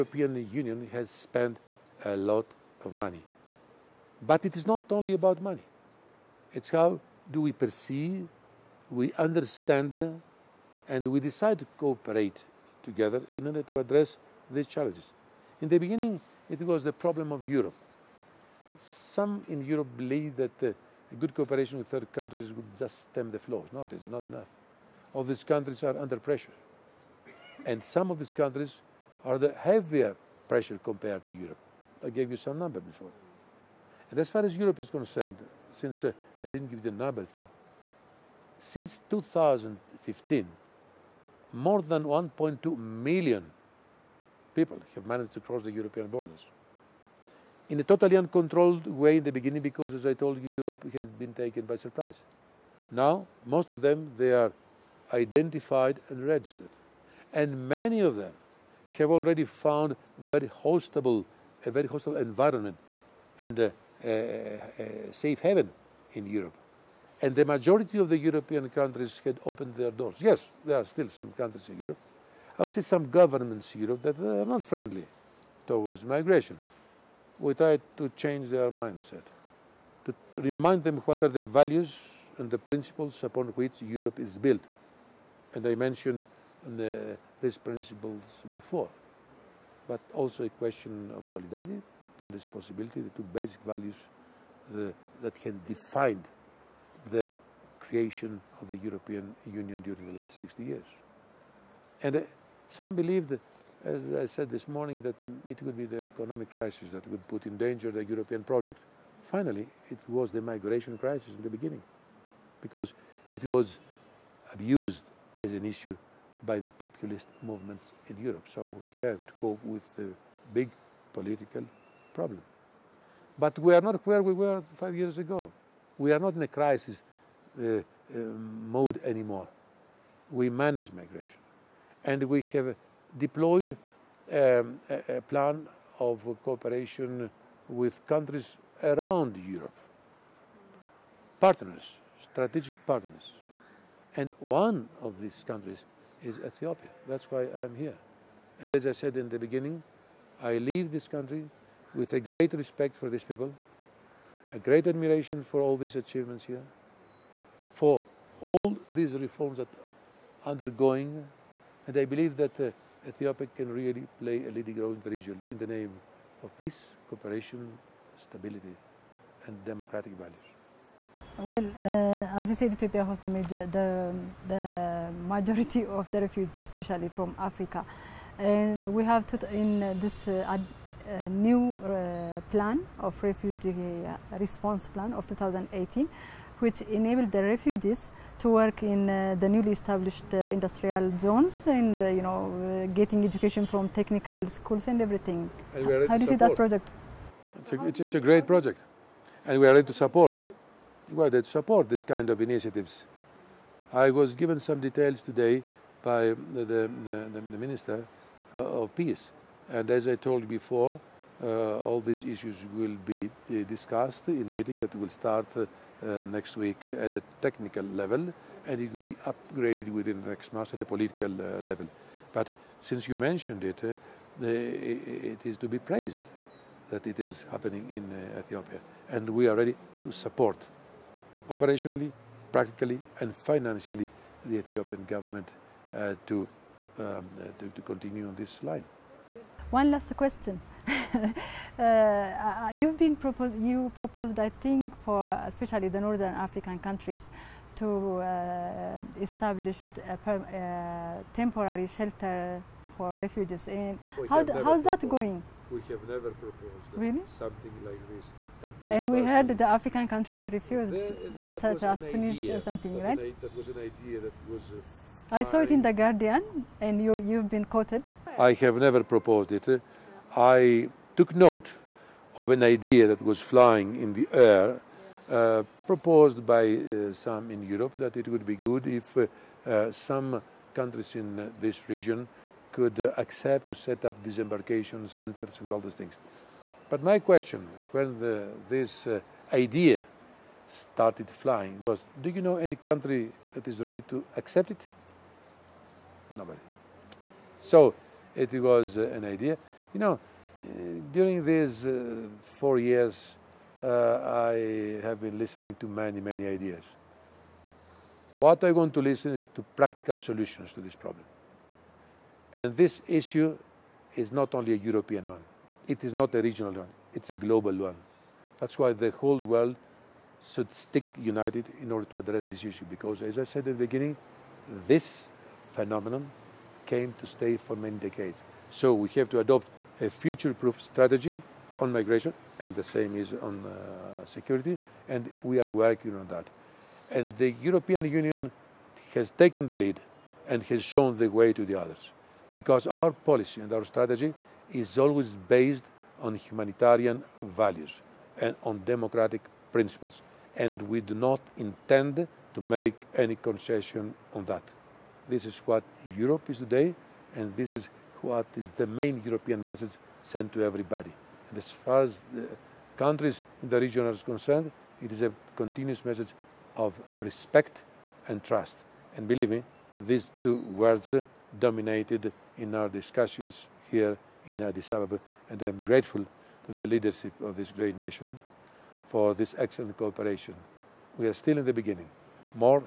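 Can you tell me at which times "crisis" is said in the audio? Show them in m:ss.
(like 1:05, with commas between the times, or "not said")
1:46, 1:50, 2:06.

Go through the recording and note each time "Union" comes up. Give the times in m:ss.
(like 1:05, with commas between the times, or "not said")
0:00, 1:39, 5:38.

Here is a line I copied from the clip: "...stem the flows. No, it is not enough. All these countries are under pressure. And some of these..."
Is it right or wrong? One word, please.
right.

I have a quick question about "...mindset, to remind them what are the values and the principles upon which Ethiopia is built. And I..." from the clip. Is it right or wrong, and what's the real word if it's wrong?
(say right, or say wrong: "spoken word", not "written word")
wrong: "Europe", not "Ethiopia".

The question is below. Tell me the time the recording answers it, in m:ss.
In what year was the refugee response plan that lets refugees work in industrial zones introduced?
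3:05.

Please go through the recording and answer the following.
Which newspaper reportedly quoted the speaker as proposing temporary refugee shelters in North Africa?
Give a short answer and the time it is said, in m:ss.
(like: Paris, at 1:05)
The Guardian, at 4:25.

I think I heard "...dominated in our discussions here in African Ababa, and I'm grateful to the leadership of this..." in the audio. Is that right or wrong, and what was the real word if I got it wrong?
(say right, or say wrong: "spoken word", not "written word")
wrong: "Addis", not "African".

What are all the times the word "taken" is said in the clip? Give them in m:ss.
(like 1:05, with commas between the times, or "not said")
0:51, 5:39.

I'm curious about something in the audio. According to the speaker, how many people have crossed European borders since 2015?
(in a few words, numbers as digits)
more than 1.2 million.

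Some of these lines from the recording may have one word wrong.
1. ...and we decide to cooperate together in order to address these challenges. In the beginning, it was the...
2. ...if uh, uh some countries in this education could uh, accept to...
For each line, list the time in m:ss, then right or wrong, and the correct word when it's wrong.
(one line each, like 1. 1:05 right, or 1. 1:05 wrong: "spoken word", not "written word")
1. 0:10 right
2. 4:38 wrong: "region", not "education".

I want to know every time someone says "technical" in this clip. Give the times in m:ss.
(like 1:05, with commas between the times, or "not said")
3:13, 3:37.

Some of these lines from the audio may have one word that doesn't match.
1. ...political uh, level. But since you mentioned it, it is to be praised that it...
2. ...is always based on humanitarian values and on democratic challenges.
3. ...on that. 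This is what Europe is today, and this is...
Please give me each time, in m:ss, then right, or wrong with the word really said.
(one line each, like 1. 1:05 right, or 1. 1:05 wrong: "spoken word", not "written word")
1. 3:40 right
2. 5:44 wrong: "principles", not "challenges"
3. 5:54 right.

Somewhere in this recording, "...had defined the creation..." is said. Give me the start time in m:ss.
1:35.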